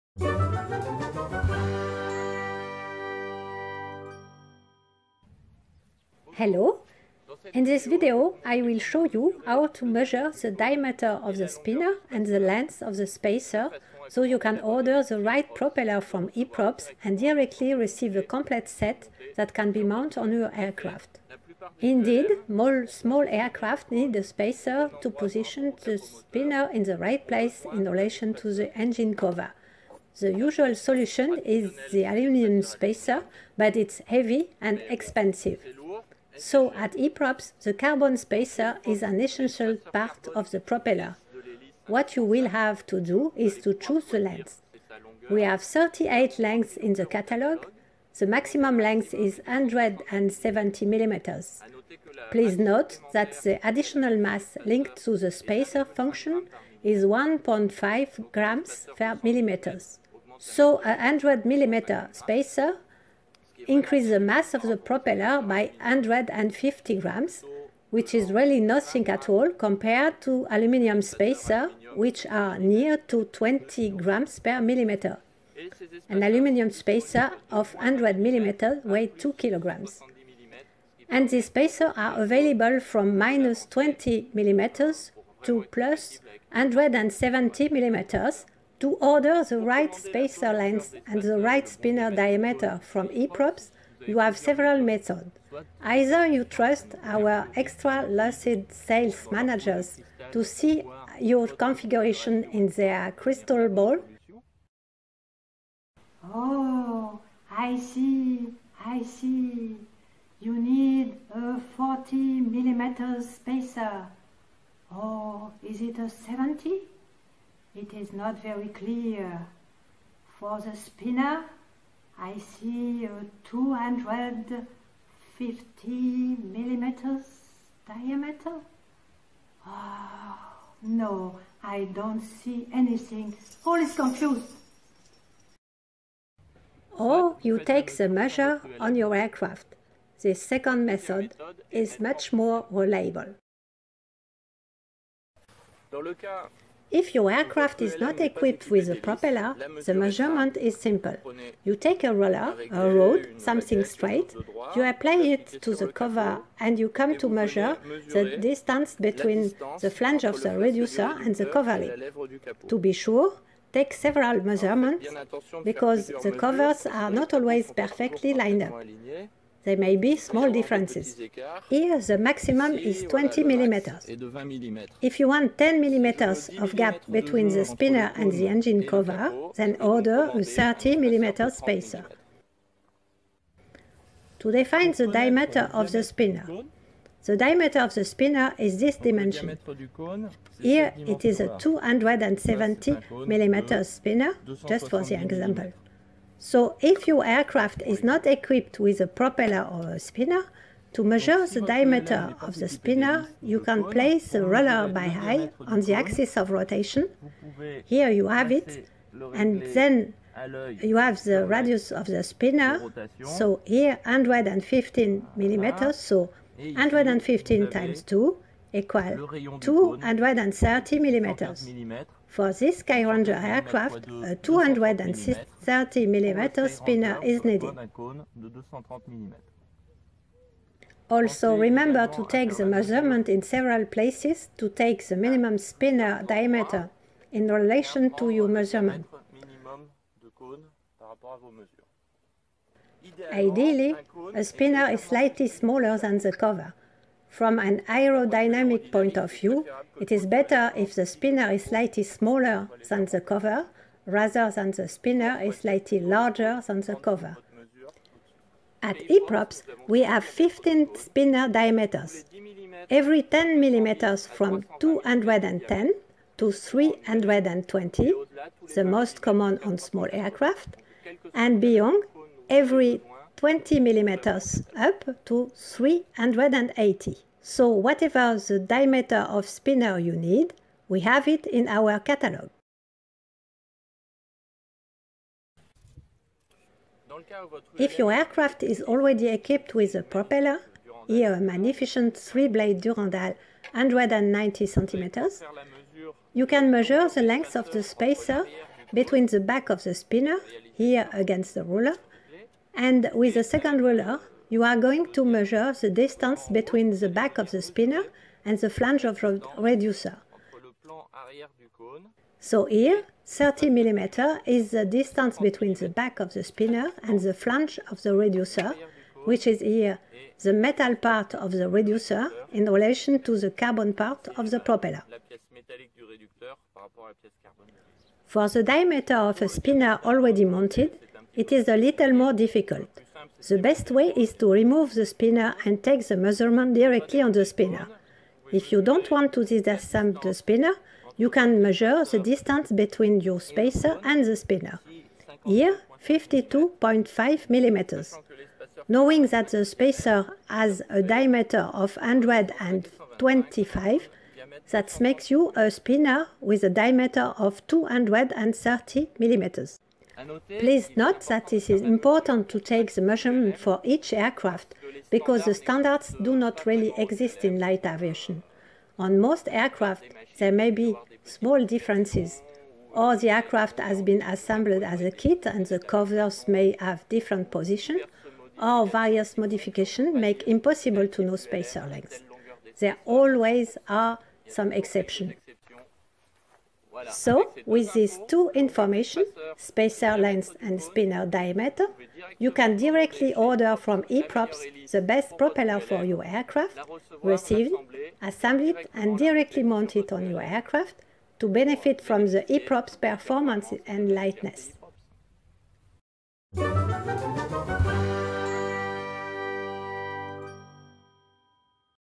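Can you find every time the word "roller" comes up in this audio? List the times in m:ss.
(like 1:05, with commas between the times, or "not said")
2:32, 3:24.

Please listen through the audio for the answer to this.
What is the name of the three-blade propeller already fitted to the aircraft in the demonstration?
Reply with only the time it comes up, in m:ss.
4:52.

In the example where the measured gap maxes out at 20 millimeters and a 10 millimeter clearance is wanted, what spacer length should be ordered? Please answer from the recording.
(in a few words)
30 millimeters.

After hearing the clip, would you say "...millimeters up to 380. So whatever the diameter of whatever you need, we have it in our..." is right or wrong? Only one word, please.
wrong.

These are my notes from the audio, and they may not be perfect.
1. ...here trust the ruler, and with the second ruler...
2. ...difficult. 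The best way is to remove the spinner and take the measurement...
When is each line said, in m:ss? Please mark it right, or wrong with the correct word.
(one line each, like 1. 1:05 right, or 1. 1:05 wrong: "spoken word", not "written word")
1. 5:00 wrong: "against", not "trust"
2. 5:32 right.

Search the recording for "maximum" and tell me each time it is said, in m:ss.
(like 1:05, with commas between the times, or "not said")
0:48, 2:52.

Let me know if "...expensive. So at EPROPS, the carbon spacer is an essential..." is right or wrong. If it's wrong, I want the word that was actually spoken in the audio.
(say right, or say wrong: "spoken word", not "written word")
right.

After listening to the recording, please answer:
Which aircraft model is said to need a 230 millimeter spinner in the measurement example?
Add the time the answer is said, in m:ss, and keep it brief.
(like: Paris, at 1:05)
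Skyranger, at 3:42.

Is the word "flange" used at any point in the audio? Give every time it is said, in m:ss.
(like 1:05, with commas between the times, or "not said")
2:39, 5:08, 5:17.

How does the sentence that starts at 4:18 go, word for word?
At EPROPS, we have 15 spinner diameters.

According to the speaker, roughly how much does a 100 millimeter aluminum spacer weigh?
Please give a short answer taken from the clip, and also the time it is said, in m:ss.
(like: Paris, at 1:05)
2 kilograms, at 1:19.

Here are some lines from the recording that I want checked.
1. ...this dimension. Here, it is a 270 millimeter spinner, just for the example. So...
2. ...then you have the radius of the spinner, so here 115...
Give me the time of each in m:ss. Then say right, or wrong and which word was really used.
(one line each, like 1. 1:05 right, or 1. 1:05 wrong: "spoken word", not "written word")
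1. 3:08 right
2. 3:29 right.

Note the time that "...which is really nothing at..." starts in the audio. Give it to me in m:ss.
1:07.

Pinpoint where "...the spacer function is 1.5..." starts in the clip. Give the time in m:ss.
0:55.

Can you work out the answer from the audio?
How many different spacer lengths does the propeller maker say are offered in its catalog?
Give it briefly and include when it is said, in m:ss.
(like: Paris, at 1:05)
38, at 0:45.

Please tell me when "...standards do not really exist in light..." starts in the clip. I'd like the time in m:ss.
6:05.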